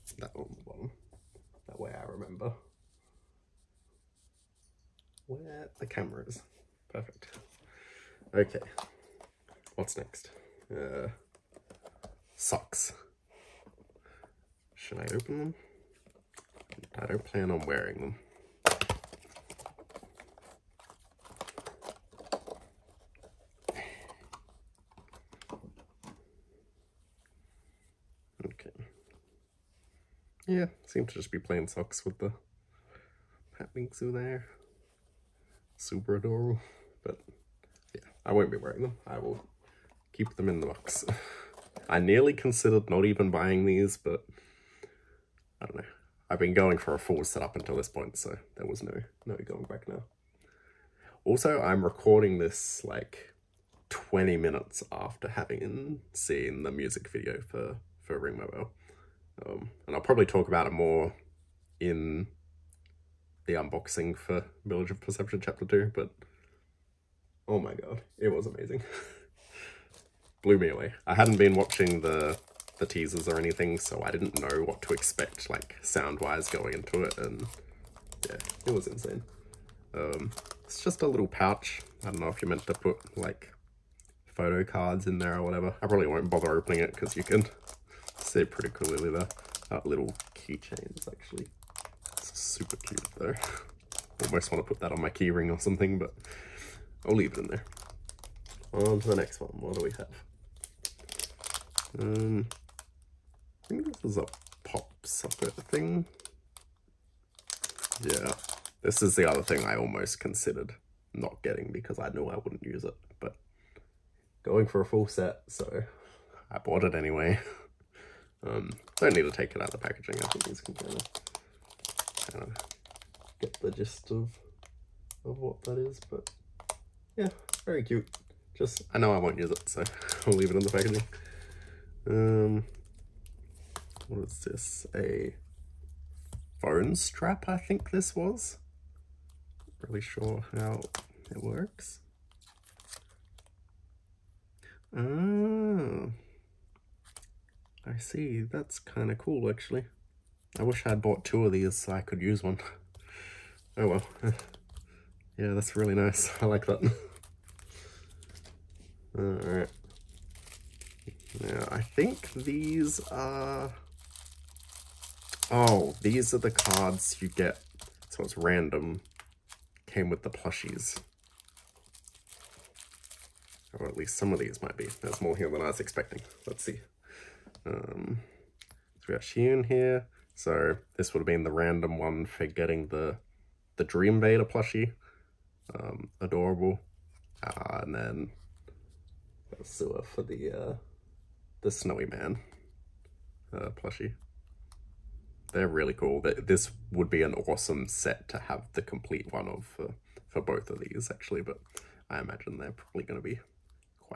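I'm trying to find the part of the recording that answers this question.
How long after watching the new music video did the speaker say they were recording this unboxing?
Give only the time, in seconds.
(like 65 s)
53 s.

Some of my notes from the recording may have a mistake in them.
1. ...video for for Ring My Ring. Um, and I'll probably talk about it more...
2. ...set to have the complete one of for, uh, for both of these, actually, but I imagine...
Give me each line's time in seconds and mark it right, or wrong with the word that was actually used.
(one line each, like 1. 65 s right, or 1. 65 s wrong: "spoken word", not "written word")
1. 57 s wrong: "Bell", not "Ring"
2. 197 s right.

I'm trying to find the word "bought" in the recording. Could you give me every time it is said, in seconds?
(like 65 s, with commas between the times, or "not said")
116 s, 151 s.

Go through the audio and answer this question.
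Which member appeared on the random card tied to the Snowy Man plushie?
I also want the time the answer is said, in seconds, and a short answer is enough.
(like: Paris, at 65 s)
Sua, at 189 s.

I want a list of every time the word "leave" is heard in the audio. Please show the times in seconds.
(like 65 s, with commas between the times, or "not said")
97 s, 130 s.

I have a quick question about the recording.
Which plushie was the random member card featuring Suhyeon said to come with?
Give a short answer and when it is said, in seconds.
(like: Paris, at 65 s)
Dream Vader, at 183 s.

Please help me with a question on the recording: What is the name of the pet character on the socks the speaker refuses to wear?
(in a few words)
Bingsu.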